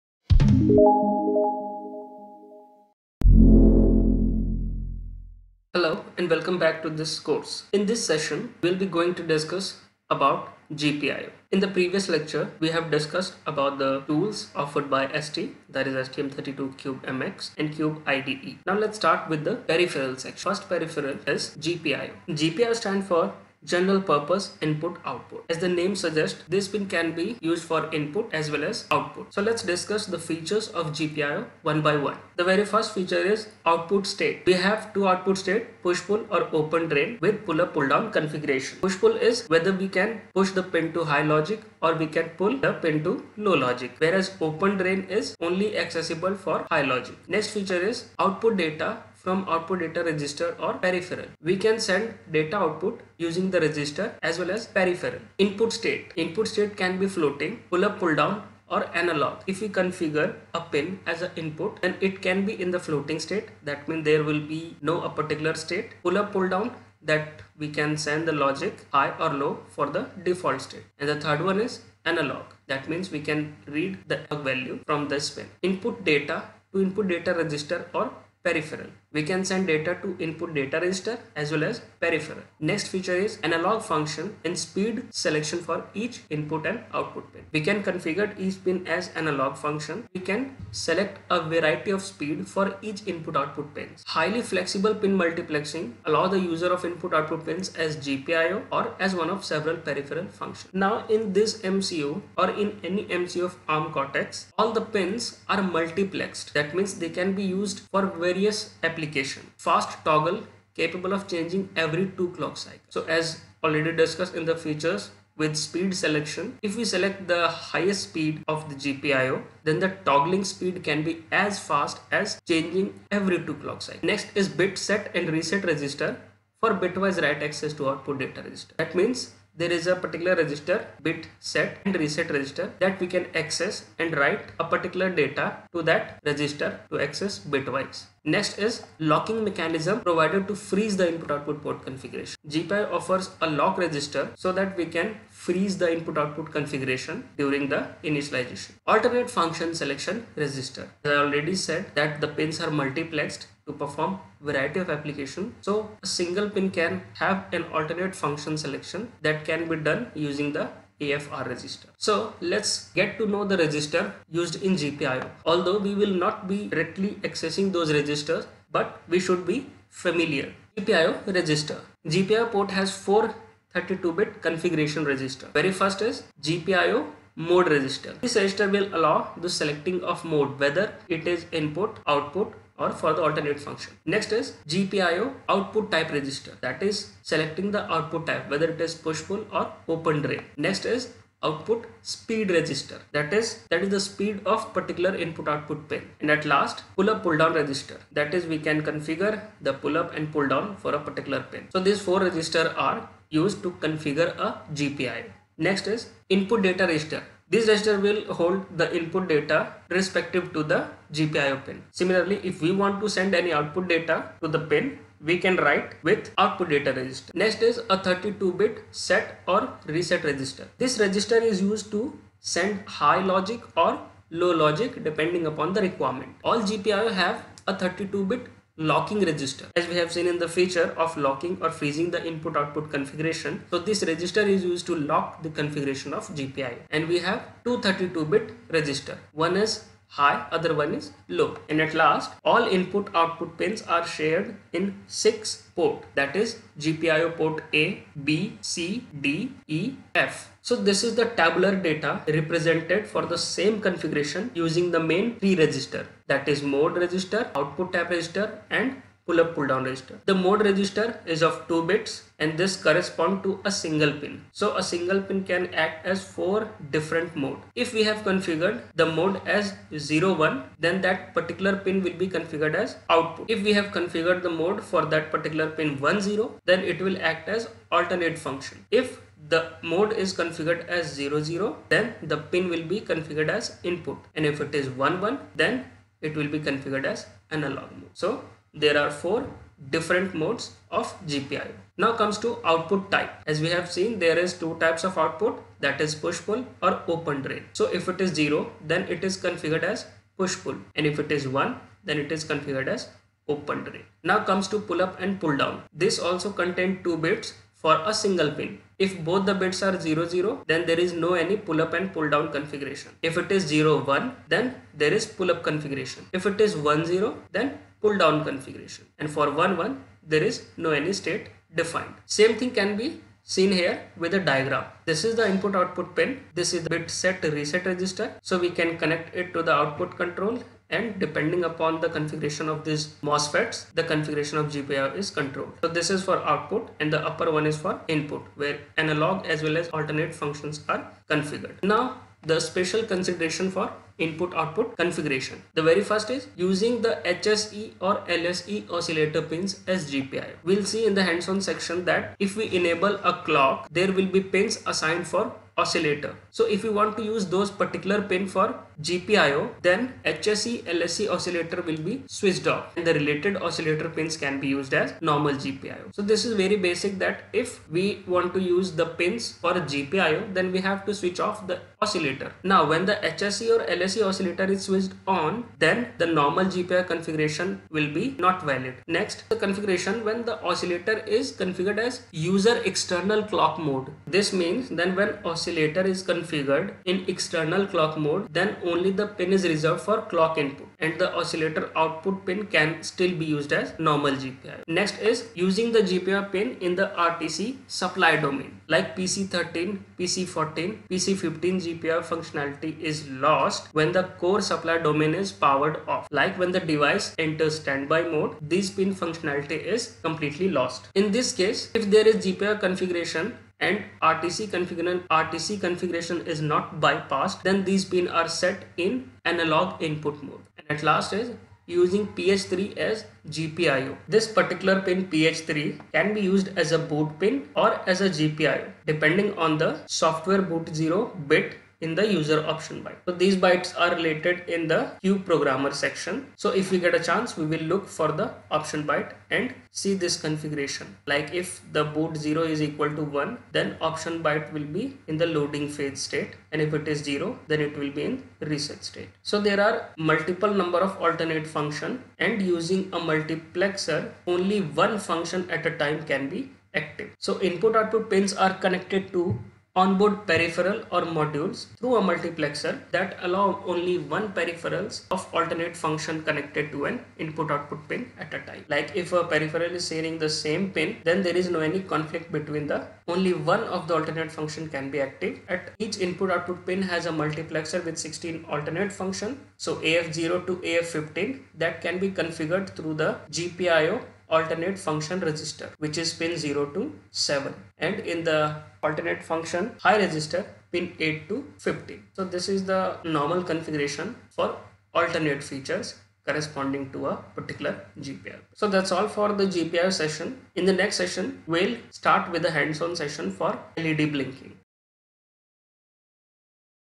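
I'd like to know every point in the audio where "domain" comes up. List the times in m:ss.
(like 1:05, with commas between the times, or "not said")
6:38, 6:44.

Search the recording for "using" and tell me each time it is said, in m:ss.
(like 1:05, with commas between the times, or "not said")
0:53, 2:40, 4:14, 5:46, 6:35, 7:01, 7:32.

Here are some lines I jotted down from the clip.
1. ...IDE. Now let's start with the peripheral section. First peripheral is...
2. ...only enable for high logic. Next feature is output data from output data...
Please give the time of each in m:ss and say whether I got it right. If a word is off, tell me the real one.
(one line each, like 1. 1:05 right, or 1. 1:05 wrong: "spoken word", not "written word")
1. 0:18 right
2. 0:45 wrong: "accessible", not "enable".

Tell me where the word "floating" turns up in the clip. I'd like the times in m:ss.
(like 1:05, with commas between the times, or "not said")
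0:57, 1:02.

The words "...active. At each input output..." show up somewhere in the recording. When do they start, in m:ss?
7:55.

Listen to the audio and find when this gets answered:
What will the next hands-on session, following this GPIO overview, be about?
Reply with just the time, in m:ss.
8:23.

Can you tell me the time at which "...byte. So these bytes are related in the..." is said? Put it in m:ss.
7:13.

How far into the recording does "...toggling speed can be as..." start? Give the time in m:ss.
2:00.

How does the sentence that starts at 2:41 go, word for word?
So let's get to know the register used in GPIO.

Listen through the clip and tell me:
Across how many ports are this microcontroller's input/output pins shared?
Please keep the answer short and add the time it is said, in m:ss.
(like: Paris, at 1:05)
6, at 4:05.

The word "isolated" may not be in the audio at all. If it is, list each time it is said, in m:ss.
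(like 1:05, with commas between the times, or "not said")
not said.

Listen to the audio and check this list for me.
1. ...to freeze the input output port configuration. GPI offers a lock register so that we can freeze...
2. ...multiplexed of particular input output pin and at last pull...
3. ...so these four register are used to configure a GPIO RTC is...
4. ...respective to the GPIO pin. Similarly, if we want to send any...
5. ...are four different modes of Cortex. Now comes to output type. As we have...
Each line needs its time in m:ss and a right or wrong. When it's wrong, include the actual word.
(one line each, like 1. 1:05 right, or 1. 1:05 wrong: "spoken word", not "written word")
1. 2:20 right
2. 3:14 wrong: "speed", not "multiplexed"
3. 3:21 wrong: "Next", not "RTC"
4. 3:29 right
5. 4:48 wrong: "GPIO", not "Cortex".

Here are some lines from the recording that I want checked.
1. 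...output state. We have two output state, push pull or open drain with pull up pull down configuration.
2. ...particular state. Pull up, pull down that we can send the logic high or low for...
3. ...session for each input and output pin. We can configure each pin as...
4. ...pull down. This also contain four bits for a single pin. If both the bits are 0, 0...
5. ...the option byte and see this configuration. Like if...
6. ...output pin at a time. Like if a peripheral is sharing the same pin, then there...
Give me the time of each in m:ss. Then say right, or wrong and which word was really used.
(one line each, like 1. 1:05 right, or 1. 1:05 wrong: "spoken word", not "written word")
1. 0:33 right
2. 1:05 right
3. 1:25 wrong: "selection", not "session"
4. 5:05 wrong: "two", not "four"
5. 7:18 right
6. 7:47 right.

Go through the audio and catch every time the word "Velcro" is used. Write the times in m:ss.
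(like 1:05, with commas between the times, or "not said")
not said.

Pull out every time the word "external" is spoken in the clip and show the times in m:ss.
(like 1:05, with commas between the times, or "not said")
6:22, 6:27.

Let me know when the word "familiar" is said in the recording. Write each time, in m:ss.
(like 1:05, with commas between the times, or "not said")
2:49.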